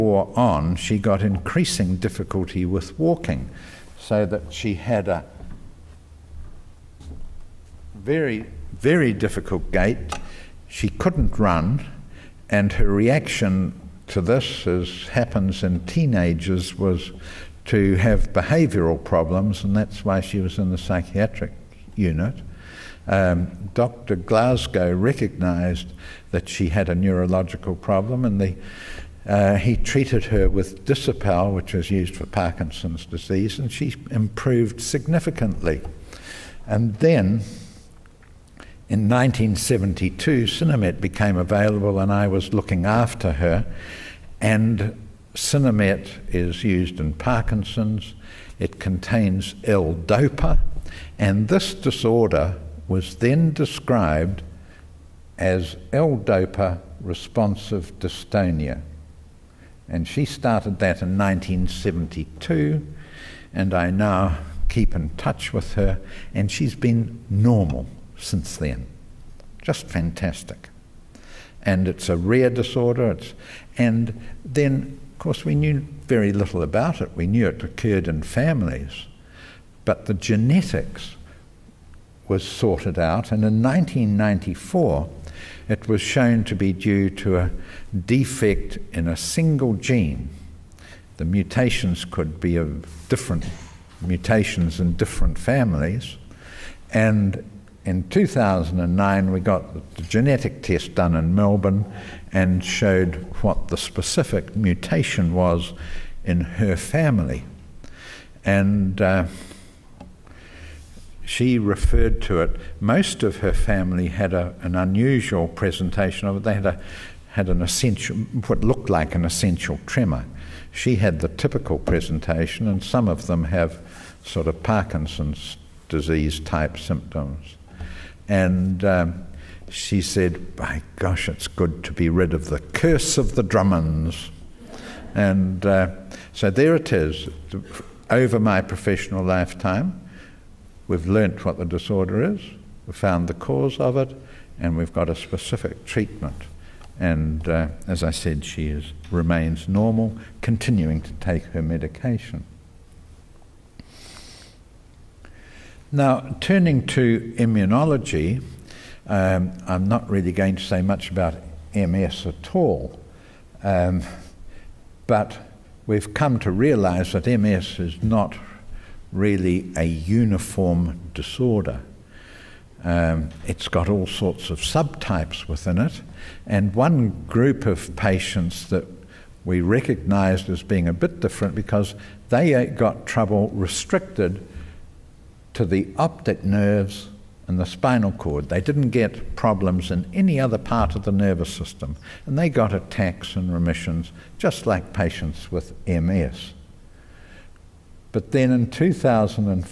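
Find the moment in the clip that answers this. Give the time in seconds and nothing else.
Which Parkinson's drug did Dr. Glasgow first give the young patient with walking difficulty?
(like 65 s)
30 s.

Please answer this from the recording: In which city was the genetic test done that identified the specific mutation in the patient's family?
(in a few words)
Melbourne.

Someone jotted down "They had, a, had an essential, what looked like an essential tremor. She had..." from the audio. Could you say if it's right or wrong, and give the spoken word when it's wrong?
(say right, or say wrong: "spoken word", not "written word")
right.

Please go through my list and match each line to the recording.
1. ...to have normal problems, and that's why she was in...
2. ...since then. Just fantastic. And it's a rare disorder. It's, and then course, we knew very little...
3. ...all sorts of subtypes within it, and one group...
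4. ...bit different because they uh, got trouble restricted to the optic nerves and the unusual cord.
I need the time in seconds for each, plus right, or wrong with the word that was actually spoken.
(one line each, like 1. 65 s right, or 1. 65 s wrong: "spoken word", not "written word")
1. 17 s wrong: "behavioural", not "normal"
2. 68 s right
3. 173 s right
4. 180 s wrong: "spinal", not "unusual".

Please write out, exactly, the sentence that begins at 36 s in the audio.
And then in 1972, Sinemet became available, and I was looking after her.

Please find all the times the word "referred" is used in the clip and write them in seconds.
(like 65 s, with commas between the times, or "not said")
111 s.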